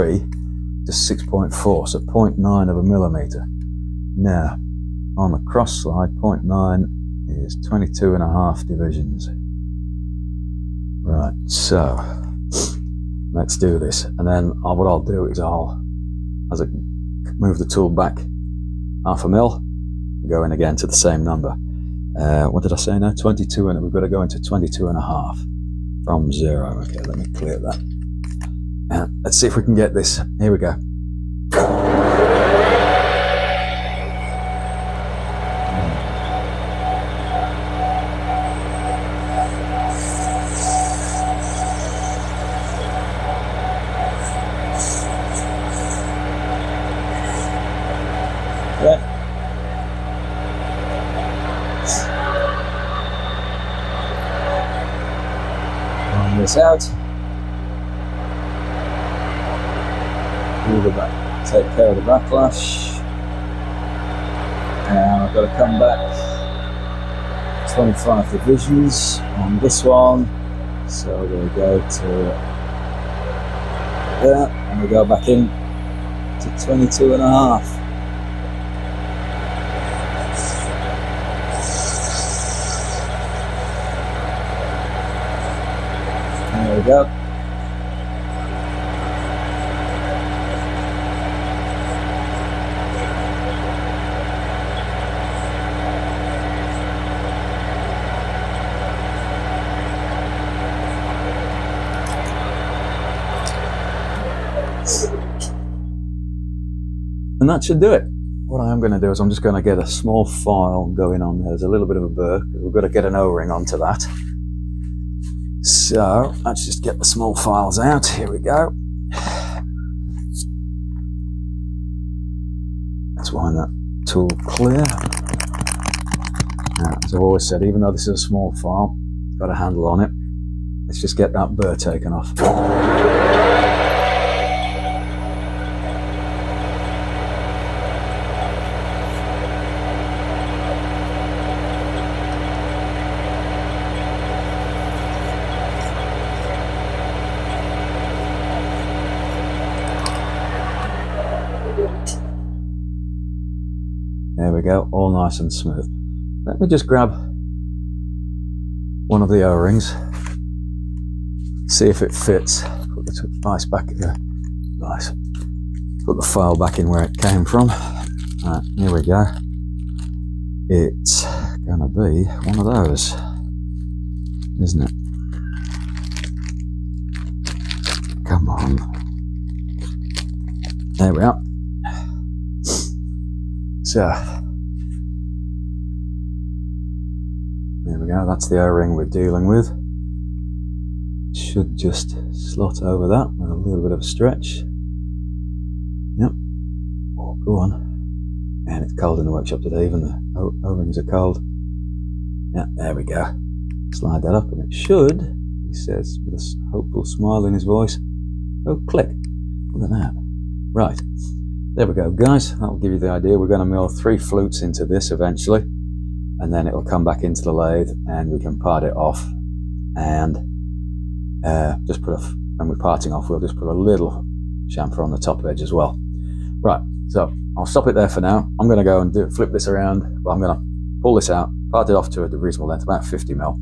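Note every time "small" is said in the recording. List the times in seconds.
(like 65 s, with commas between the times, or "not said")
109 s, 117 s, 128 s.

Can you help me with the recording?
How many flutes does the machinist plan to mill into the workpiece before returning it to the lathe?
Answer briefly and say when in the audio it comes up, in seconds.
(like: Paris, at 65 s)
3, at 213 s.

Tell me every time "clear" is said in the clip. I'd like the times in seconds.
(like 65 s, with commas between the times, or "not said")
27 s, 124 s.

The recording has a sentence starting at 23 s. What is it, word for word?
22 and we've got to go into 22 and a half from zero.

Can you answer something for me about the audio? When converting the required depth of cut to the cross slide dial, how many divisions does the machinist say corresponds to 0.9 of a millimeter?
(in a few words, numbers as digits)
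22.5.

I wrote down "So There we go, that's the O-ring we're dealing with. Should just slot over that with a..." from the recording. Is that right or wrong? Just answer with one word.
right.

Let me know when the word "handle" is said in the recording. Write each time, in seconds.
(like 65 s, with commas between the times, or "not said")
129 s.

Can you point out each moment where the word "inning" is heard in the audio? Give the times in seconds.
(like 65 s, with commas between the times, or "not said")
not said.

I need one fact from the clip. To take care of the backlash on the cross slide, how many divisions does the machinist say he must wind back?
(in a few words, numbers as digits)
25.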